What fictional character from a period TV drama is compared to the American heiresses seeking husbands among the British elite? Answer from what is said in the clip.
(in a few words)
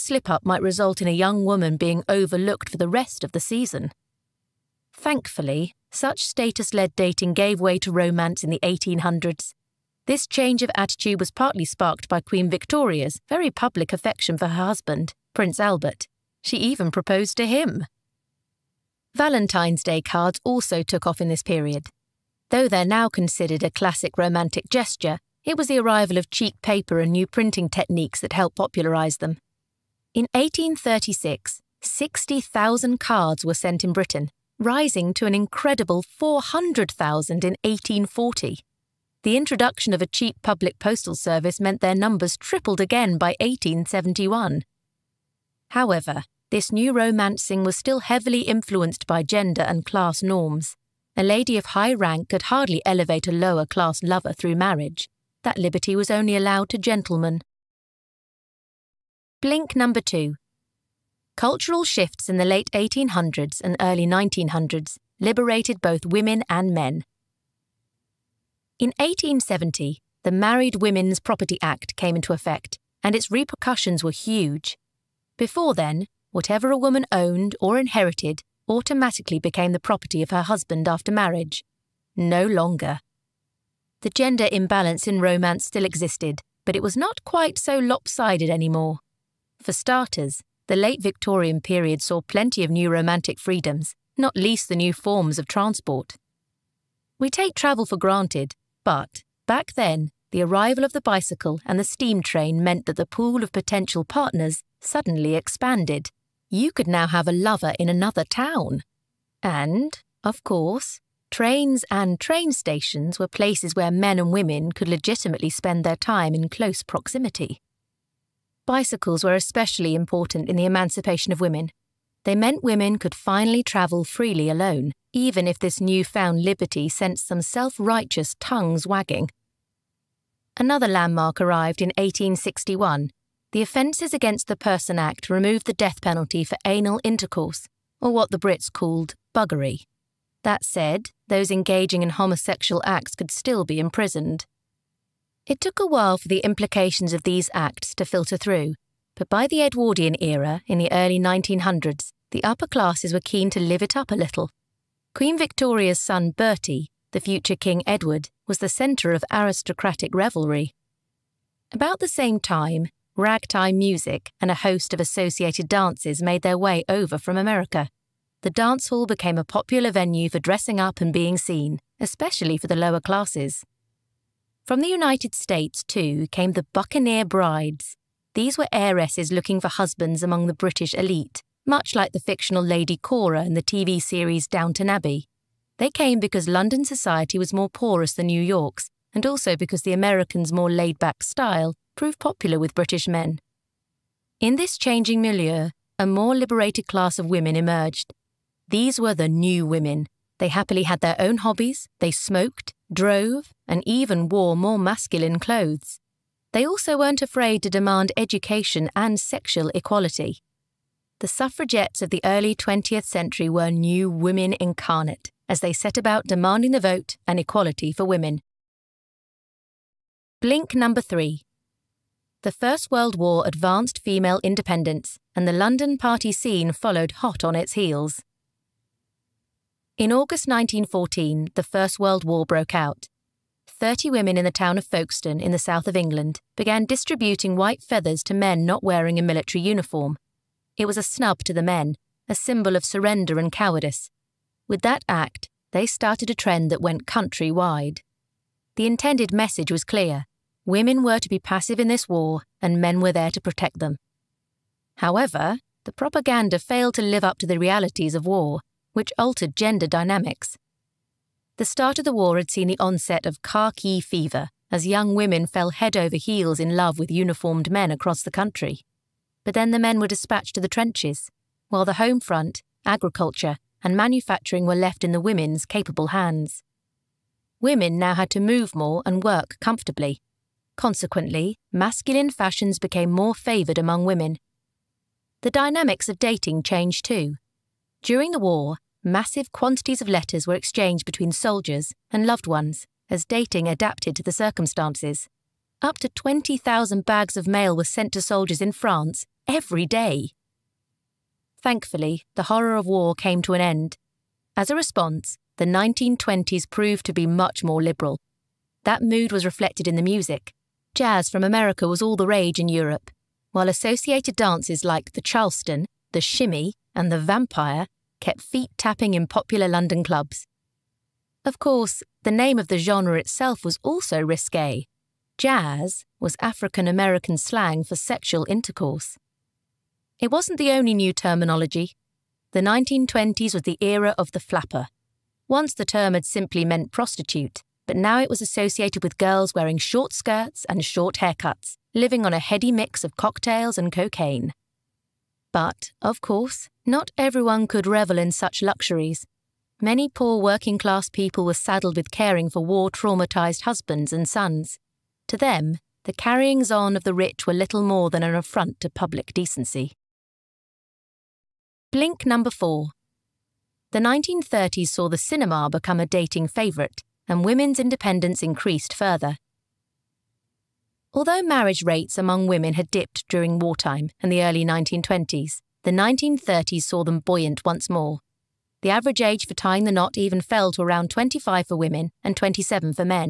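Lady Cora.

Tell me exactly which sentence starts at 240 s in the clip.
It was a snub to the men, a symbol of surrender and cowardice.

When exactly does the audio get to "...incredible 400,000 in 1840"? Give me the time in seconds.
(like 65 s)
35 s.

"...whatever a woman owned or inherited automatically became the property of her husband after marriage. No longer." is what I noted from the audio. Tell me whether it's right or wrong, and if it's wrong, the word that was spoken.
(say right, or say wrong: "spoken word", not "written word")
right.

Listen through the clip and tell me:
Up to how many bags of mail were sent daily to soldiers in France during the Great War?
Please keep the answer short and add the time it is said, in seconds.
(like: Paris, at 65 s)
20,000, at 296 s.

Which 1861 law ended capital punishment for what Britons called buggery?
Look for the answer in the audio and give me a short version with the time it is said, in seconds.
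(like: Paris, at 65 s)
The Offences Against the Person Act, at 133 s.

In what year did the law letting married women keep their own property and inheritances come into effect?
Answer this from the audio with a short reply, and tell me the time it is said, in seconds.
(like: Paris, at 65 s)
1870, at 68 s.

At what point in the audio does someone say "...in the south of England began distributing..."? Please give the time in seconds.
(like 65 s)
235 s.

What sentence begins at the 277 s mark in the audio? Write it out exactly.
Women now had to move more and work comfortably.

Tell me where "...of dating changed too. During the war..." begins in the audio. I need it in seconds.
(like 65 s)
286 s.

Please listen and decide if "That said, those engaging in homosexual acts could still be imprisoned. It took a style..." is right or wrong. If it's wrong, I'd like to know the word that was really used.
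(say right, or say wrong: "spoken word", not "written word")
wrong: "while", not "style".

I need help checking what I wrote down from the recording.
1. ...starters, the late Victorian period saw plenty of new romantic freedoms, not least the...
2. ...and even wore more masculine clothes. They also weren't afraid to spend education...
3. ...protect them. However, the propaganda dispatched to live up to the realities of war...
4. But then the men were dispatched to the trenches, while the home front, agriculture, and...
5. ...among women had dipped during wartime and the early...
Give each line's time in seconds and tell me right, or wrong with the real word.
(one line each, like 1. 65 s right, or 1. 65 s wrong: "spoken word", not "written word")
1. 89 s right
2. 203 s wrong: "demand", not "spend"
3. 253 s wrong: "failed", not "dispatched"
4. 269 s right
5. 372 s right.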